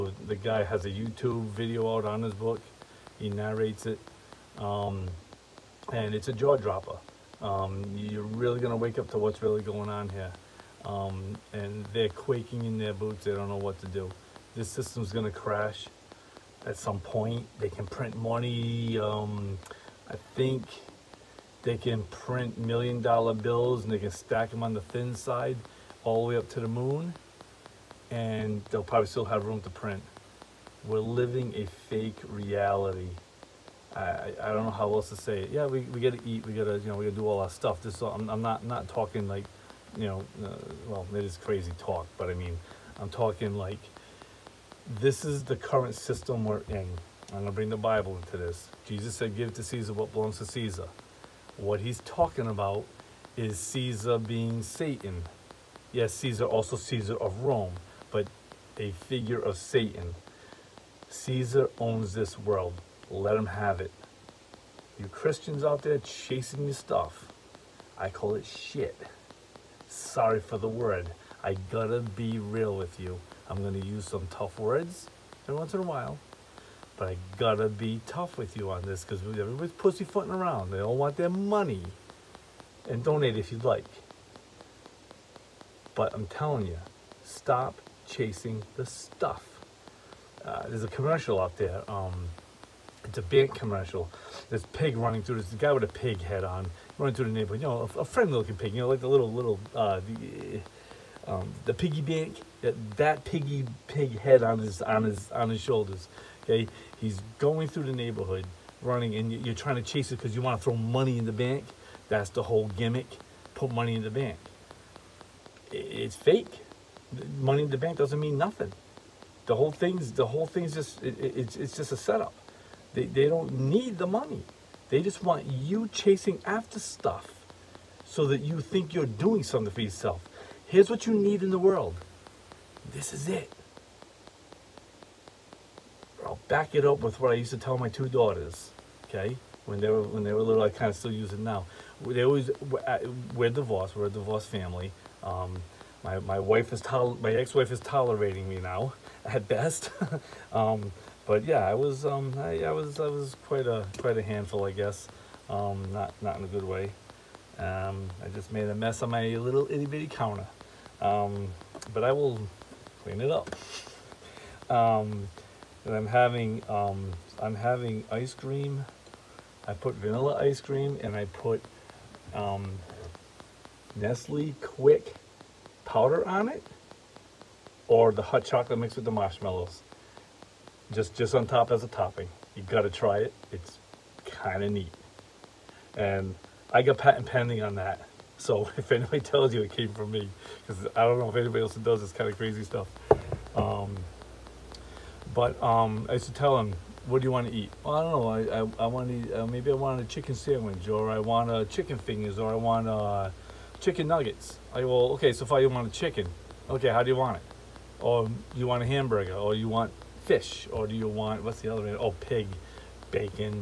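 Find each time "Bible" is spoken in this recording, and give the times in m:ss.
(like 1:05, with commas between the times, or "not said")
0:47.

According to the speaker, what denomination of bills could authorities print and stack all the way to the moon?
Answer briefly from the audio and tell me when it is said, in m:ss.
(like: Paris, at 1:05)
million dollar bills, at 0:22.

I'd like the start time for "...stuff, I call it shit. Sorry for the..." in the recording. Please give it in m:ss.
1:06.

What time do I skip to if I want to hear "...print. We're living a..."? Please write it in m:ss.
0:29.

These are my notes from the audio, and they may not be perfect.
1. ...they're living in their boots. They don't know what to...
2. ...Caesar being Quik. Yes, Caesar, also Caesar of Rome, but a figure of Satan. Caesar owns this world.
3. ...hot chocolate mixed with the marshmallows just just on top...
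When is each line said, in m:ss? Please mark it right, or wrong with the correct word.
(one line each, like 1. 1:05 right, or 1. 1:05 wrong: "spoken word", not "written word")
1. 0:11 wrong: "quaking", not "living"
2. 0:53 wrong: "Satan", not "Quik"
3. 2:58 right.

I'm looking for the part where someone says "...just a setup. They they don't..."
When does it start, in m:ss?
2:01.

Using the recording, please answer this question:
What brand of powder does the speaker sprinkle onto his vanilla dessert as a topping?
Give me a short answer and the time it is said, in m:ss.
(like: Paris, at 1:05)
Nestle Quik, at 2:53.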